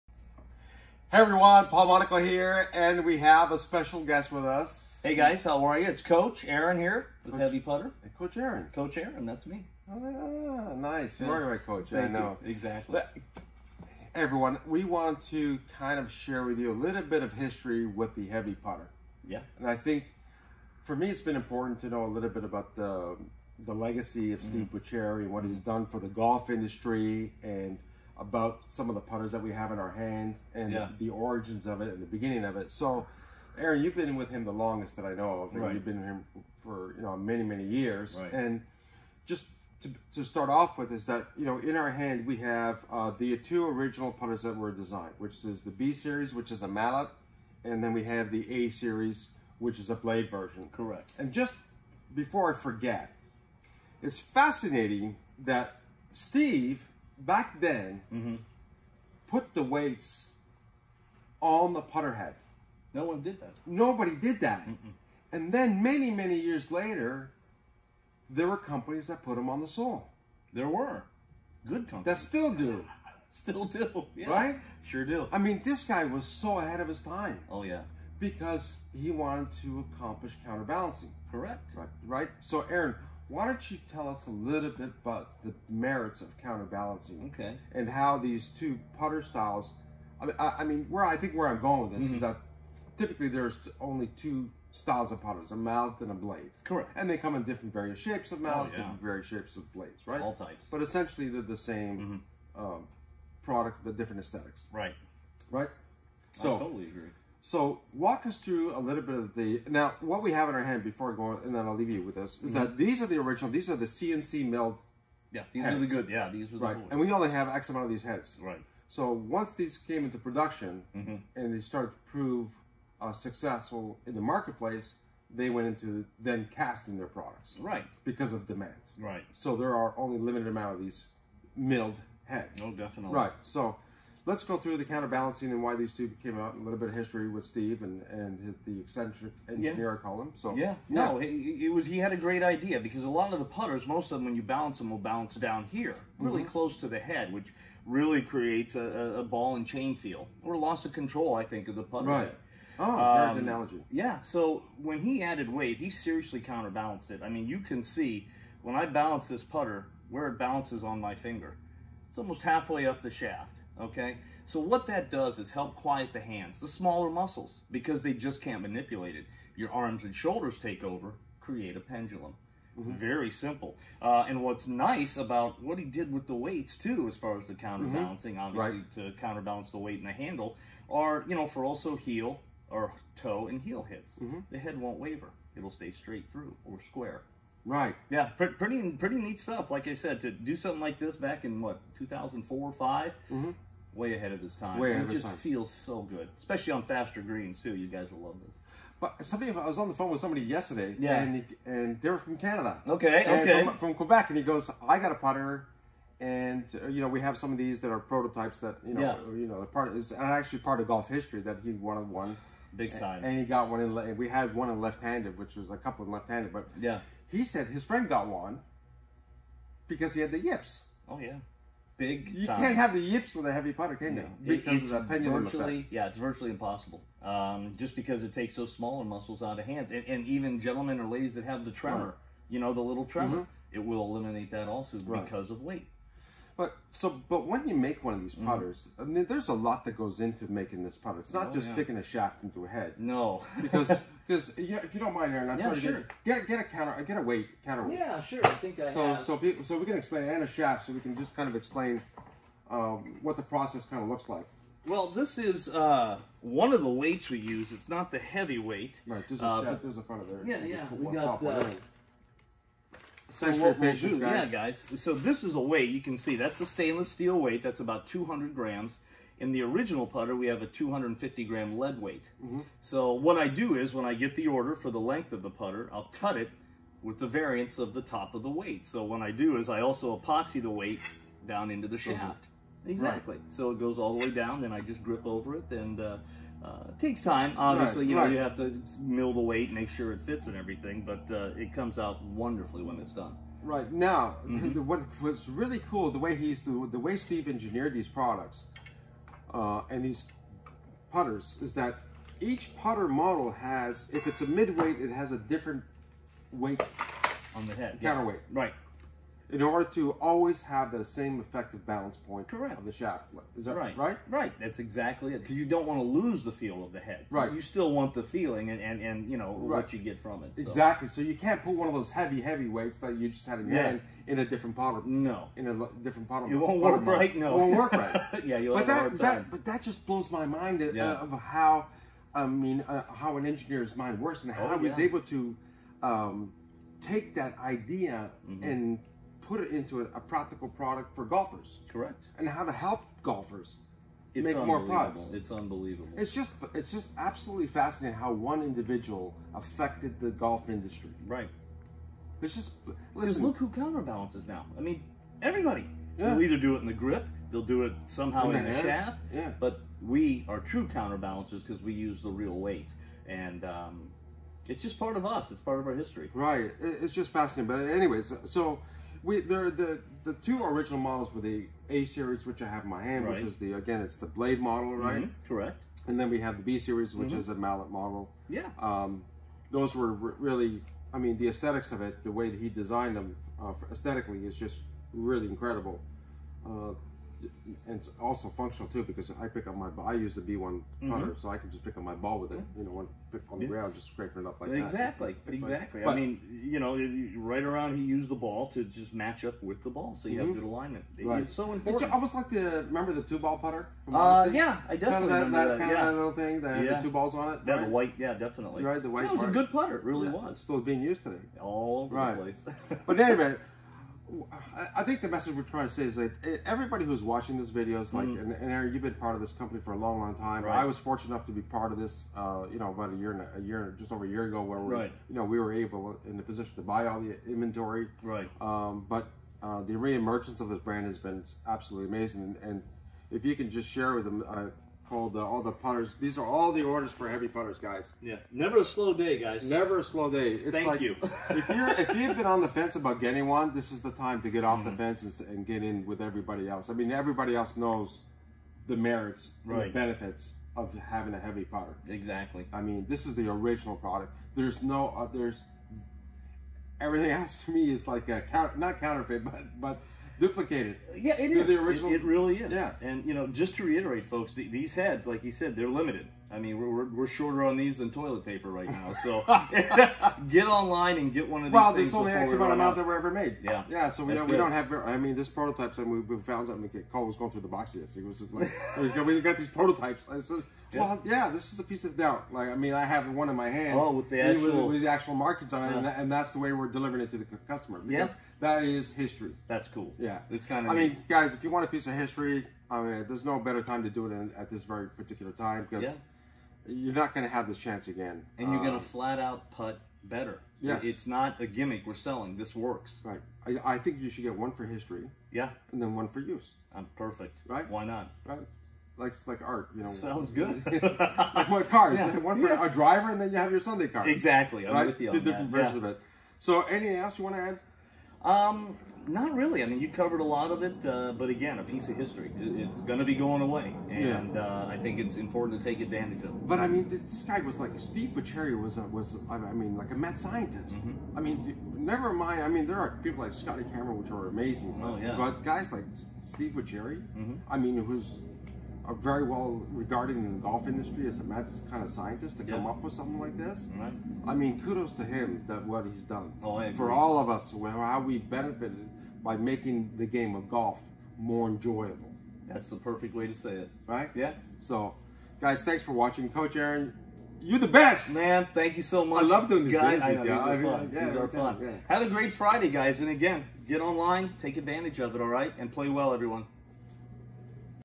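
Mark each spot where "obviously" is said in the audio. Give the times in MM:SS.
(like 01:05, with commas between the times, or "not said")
02:58, 04:47.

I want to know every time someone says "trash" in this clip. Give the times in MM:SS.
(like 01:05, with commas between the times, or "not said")
not said.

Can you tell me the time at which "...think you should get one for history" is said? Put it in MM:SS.
08:23.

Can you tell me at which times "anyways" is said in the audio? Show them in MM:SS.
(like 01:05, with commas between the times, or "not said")
06:07, 06:53.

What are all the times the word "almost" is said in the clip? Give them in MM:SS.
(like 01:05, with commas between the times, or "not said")
02:42, 06:42.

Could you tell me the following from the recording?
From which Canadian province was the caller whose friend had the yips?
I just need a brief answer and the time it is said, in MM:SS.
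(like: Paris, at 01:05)
Quebec, at 03:23.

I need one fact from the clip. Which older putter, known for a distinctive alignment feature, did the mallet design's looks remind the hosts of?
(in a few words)
Two ball putter.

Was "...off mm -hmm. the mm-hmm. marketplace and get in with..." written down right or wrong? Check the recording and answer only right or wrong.
wrong.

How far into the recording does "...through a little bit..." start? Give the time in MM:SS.
01:48.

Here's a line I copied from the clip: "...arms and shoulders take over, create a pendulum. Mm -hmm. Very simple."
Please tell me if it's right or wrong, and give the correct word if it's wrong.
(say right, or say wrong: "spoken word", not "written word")
right.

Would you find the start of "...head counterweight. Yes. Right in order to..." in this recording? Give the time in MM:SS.
05:07.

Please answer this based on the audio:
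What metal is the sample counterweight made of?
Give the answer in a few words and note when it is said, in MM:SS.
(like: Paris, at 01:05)
Stainless steel, at 04:26.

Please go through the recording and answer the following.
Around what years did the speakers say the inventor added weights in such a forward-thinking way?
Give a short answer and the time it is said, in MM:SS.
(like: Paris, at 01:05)
2004-2005, at 03:11.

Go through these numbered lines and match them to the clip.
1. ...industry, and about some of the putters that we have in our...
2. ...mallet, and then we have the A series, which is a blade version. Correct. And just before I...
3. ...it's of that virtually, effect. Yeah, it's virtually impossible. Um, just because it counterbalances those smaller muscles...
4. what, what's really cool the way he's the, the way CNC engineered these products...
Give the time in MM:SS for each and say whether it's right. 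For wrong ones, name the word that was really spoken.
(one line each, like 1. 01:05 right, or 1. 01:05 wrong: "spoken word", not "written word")
1. 00:26 right
2. 00:46 right
3. 03:44 wrong: "takes", not "counterbalances"
4. 04:54 wrong: "Steve", not "CNC".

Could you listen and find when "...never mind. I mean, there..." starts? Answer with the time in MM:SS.
08:51.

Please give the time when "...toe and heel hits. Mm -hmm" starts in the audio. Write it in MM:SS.
03:03.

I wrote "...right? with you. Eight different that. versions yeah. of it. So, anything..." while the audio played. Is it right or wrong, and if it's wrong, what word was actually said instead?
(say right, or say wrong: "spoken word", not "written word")
wrong: "Two", not "Eight".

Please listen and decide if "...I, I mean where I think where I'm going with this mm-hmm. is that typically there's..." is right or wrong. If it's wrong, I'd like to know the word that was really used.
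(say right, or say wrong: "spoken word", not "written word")
right.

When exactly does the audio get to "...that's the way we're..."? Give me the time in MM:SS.
08:06.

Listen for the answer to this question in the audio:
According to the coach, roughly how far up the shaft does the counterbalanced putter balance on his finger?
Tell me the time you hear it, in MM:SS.
02:42.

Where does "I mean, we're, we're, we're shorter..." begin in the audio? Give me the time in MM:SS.
07:46.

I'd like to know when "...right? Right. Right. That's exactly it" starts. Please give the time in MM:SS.
05:13.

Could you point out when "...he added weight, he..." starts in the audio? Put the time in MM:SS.
02:35.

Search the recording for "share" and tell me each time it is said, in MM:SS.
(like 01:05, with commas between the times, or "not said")
00:16, 07:13.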